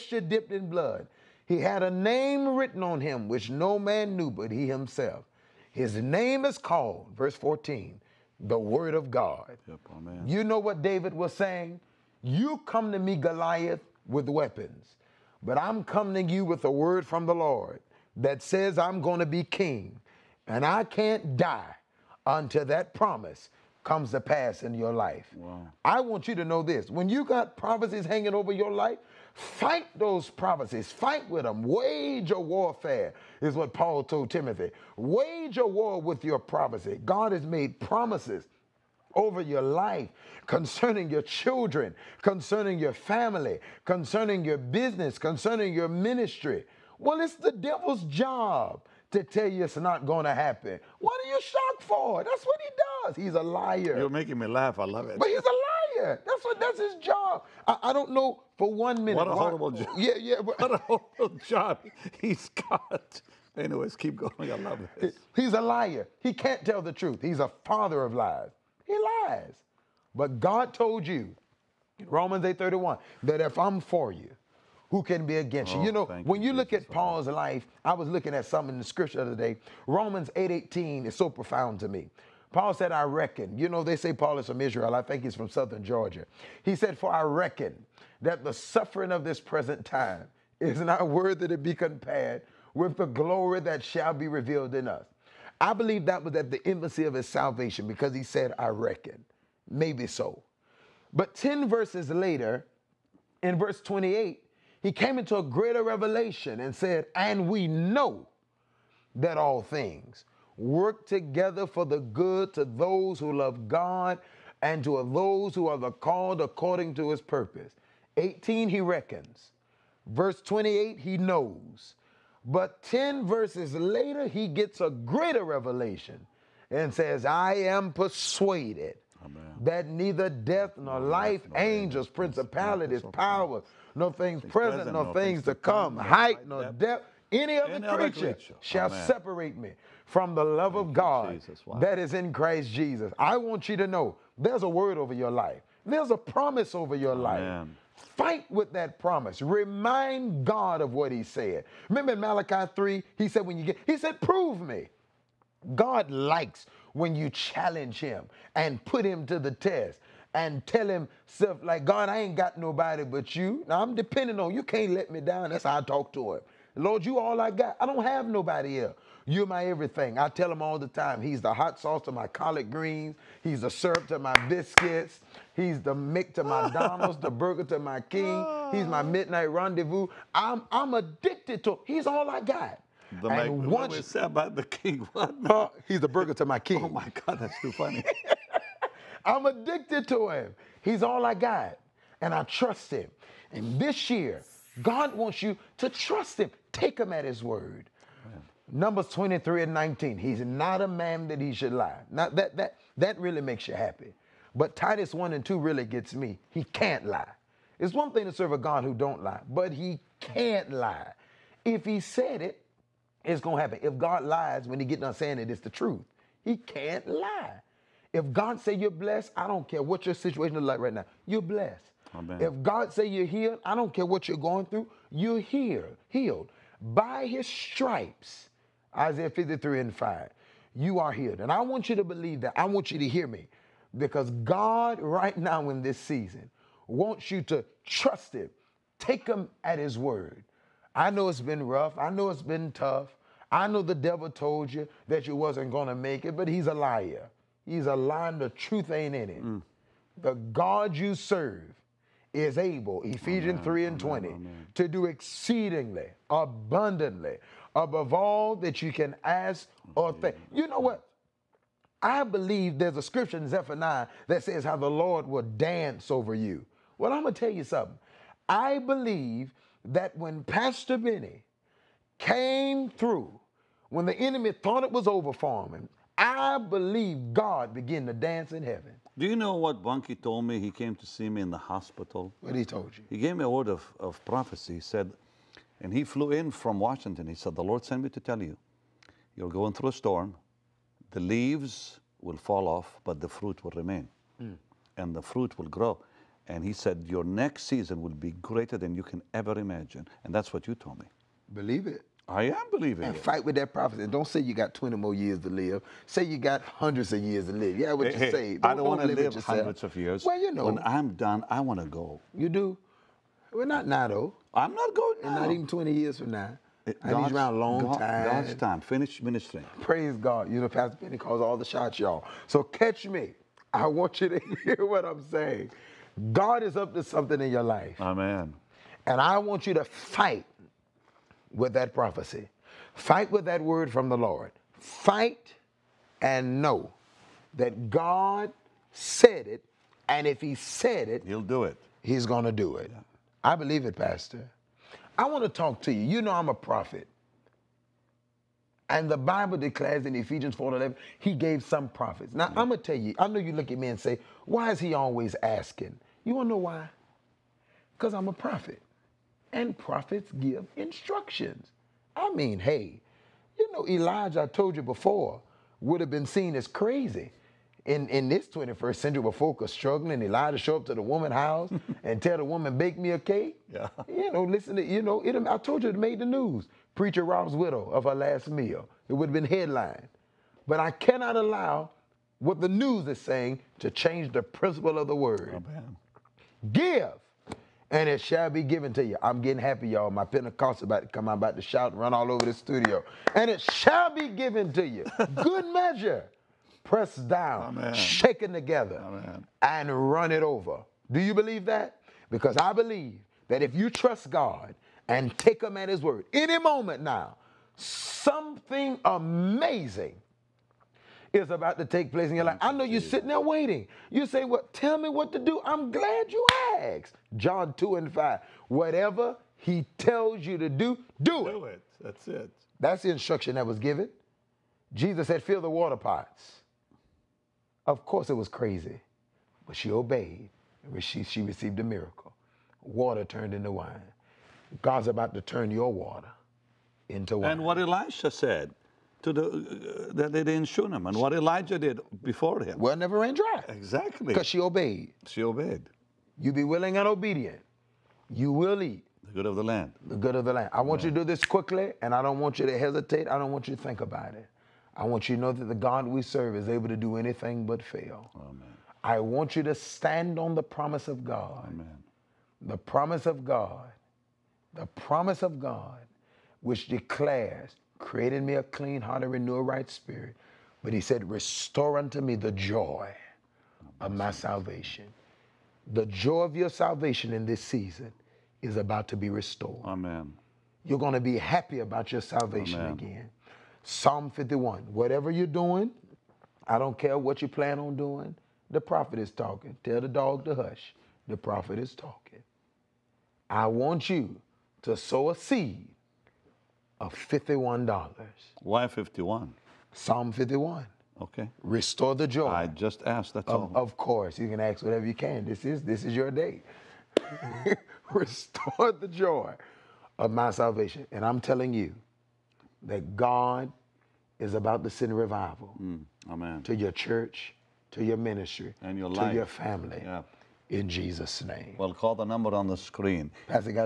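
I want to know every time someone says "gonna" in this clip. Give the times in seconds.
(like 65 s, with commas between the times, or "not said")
213 s.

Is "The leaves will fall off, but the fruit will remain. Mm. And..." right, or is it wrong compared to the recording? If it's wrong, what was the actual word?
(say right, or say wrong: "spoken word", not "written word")
right.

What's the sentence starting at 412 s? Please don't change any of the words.
I know you're sitting there waiting.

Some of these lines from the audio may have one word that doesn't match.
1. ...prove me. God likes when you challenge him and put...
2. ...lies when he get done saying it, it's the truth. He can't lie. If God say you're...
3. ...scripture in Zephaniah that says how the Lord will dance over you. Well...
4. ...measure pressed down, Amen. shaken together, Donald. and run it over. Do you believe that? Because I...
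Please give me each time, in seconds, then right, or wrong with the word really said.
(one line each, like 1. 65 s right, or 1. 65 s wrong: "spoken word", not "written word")
1. 154 s right
2. 214 s right
3. 263 s right
4. 395 s wrong: "Amen", not "Donald".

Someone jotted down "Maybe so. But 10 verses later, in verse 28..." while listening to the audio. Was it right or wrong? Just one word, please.
right.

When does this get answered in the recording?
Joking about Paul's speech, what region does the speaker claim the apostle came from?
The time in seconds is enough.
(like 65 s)
85 s.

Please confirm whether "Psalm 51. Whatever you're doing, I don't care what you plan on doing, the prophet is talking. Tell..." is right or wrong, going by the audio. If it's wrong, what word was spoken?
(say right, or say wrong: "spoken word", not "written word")
right.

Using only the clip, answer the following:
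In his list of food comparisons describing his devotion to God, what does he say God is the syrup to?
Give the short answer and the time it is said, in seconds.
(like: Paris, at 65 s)
My biscuits, at 174 s.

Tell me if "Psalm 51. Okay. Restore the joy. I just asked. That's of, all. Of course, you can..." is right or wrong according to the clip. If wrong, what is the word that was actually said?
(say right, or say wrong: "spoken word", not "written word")
right.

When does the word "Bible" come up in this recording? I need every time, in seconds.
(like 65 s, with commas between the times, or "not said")
349 s.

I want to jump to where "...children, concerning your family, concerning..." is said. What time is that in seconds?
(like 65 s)
41 s.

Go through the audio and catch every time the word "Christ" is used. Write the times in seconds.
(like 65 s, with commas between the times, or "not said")
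142 s.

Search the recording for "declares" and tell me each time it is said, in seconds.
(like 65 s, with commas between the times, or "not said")
349 s, 466 s.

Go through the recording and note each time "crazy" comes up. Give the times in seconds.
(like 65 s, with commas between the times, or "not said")
366 s, 428 s.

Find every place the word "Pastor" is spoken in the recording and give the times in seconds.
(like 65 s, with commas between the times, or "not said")
270 s, 320 s, 343 s.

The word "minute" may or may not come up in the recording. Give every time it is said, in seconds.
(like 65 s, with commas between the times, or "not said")
59 s.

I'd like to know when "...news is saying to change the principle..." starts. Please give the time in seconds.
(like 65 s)
382 s.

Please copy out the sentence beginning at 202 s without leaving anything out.
Now that that that really makes you happy.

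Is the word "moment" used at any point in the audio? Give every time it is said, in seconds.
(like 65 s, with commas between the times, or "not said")
406 s.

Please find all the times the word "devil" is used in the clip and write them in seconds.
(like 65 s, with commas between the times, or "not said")
47 s, 243 s.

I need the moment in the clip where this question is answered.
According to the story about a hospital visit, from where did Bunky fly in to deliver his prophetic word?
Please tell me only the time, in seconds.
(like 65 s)
286 s.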